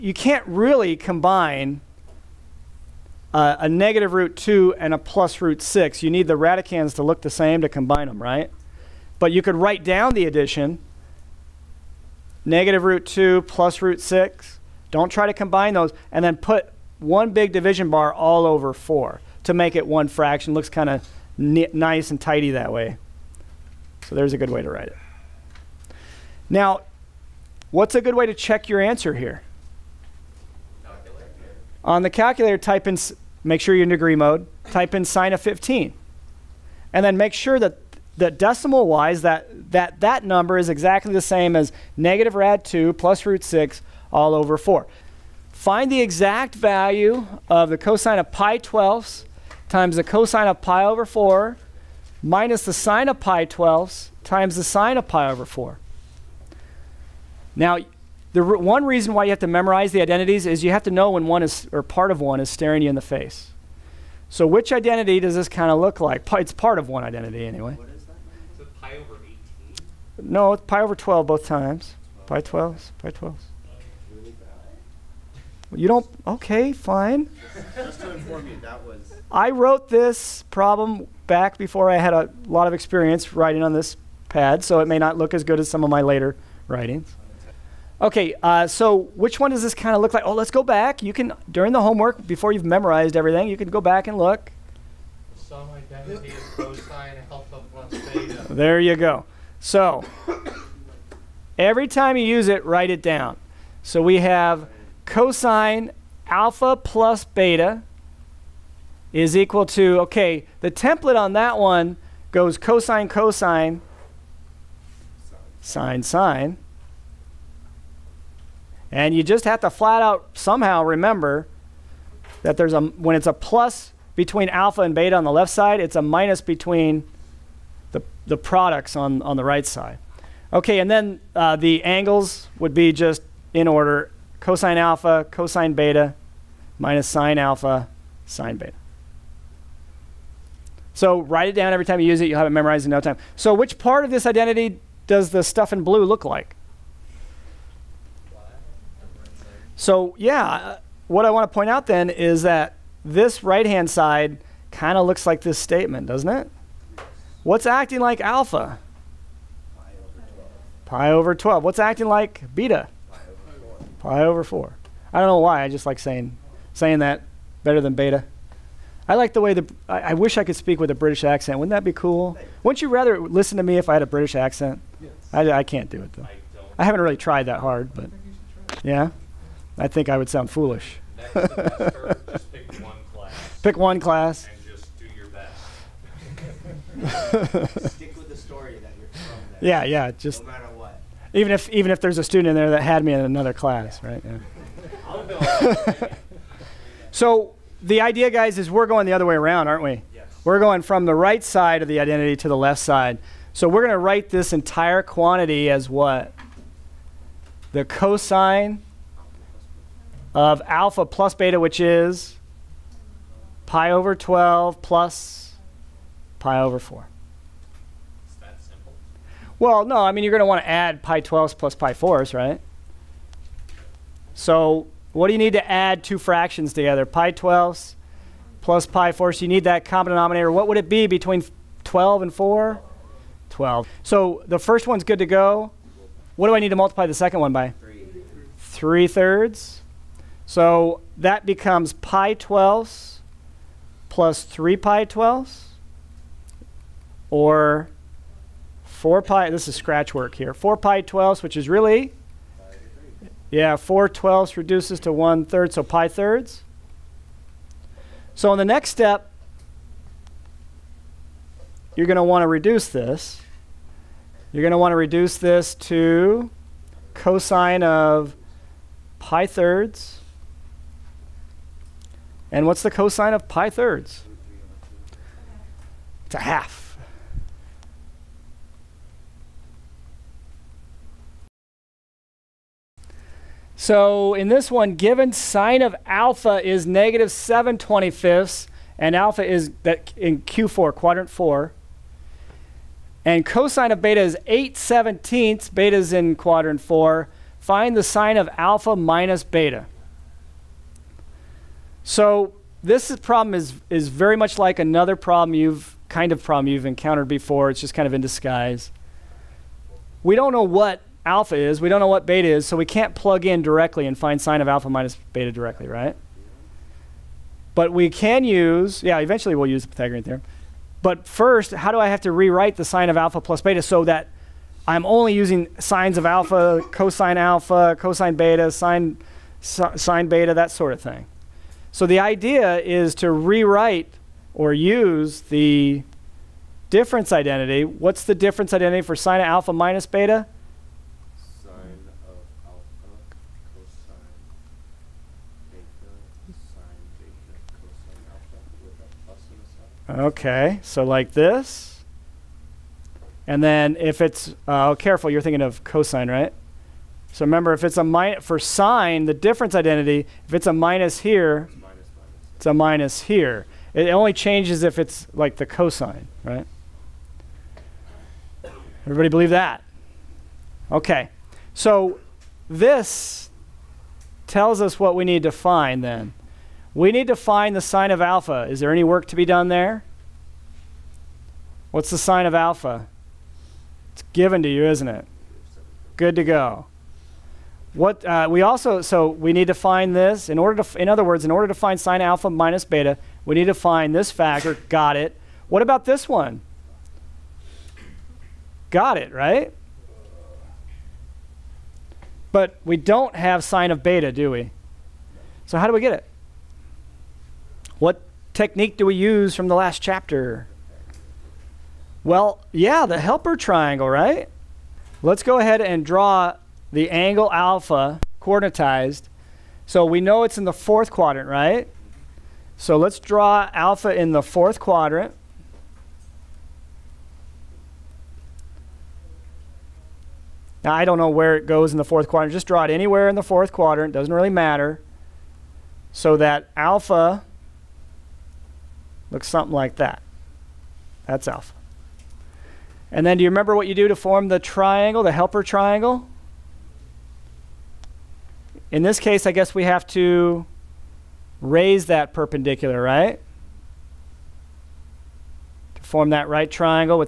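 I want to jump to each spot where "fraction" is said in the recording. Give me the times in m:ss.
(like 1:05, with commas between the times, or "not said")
0:20, 3:46.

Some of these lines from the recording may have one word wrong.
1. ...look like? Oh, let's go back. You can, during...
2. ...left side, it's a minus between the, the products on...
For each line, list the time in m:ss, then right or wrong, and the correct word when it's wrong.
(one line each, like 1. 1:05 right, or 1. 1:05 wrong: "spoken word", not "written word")
1. 1:30 right
2. 2:05 right.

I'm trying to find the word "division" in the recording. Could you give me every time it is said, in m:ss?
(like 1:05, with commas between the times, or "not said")
0:17.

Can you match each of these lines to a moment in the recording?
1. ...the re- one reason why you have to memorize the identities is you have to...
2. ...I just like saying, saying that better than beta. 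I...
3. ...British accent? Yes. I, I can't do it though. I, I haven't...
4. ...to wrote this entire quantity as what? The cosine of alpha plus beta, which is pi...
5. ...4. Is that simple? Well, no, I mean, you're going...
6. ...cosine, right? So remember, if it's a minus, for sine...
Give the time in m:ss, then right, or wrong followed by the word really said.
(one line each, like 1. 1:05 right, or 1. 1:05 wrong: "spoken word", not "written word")
1. 0:58 right
2. 2:45 right
3. 2:54 right
4. 3:23 wrong: "write", not "wrote"
5. 3:36 right
6. 5:55 right.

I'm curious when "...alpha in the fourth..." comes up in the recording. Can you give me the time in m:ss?
7:03.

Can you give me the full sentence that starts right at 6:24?
It's given to you, isn't it?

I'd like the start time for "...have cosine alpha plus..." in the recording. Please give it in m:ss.
1:44.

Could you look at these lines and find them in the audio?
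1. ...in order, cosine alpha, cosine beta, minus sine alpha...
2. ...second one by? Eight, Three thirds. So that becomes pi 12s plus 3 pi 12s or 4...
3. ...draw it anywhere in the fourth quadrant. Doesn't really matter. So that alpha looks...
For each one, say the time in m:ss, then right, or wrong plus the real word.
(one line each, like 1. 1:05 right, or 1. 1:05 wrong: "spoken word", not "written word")
1. 2:13 right
2. 3:57 wrong: "Three", not "Eight"
3. 7:12 right.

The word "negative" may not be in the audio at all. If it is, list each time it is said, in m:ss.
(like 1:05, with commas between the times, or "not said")
0:03, 0:12, 0:41, 4:46.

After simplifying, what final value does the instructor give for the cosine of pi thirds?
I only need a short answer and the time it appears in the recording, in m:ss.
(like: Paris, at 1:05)
a half, at 4:36.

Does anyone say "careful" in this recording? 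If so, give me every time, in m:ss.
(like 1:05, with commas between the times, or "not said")
5:54.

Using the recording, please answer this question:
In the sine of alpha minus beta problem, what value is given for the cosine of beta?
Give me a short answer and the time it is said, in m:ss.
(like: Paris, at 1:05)
8/17, at 4:54.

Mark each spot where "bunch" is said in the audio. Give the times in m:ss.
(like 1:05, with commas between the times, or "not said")
not said.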